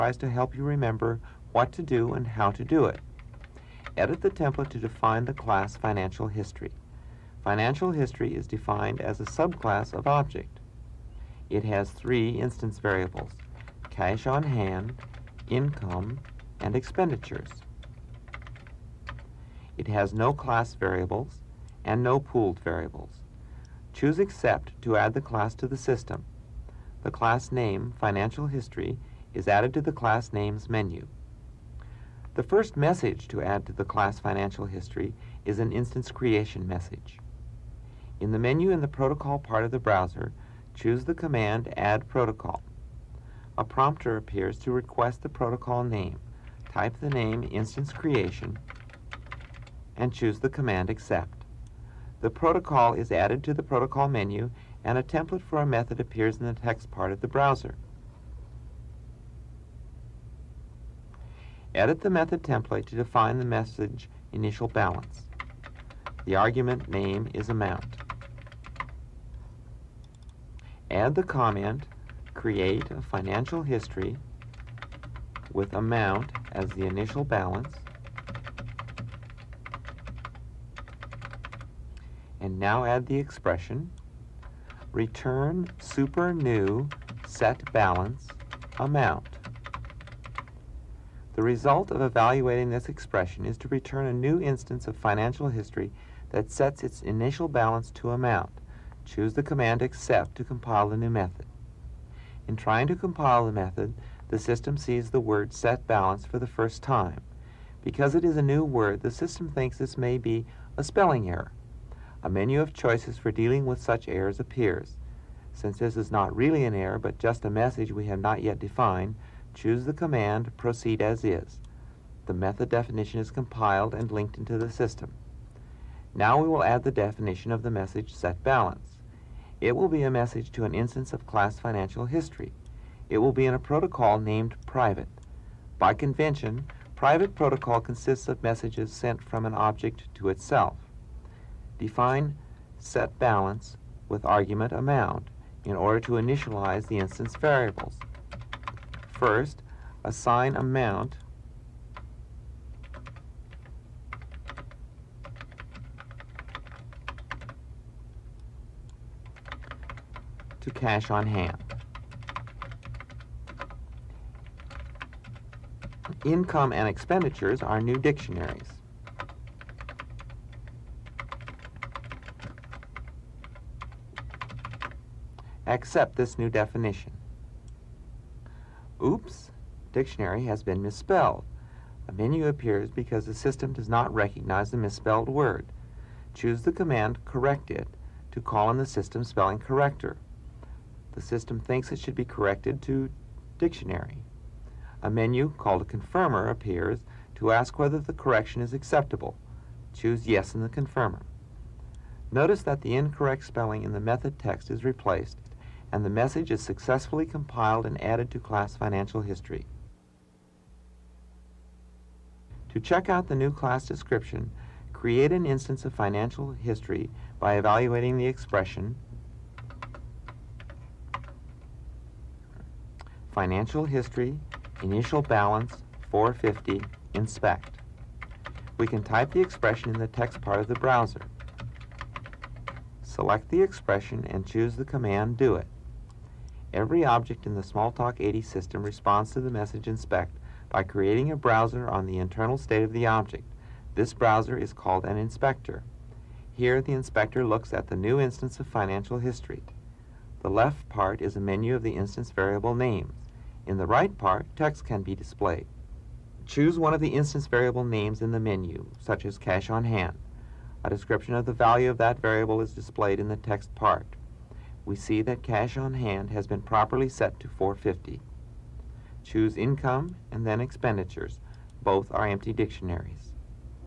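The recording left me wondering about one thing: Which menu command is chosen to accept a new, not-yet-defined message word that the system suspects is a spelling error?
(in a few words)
Proceed as is.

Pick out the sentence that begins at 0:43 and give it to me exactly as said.
A prompter appears to request the protocol name.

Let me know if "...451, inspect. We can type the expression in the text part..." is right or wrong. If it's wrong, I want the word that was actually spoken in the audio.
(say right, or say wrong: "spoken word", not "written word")
wrong: "450", not "451".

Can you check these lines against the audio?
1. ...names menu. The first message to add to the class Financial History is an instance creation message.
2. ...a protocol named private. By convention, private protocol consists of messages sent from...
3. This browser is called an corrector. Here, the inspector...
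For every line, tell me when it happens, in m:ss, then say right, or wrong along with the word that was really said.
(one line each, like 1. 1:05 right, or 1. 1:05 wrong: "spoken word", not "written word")
1. 0:30 right
2. 2:13 right
3. 4:03 wrong: "inspector", not "corrector".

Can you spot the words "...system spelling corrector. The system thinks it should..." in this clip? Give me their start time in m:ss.
3:08.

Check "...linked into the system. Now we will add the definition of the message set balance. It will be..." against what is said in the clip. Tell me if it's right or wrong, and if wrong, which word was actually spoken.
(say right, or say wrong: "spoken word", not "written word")
right.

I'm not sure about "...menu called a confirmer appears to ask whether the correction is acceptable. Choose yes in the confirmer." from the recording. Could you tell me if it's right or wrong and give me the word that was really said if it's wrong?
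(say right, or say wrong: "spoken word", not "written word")
right.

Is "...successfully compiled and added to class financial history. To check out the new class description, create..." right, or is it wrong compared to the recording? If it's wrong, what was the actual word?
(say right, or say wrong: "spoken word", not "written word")
right.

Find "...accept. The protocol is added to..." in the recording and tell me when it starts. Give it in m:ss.
0:50.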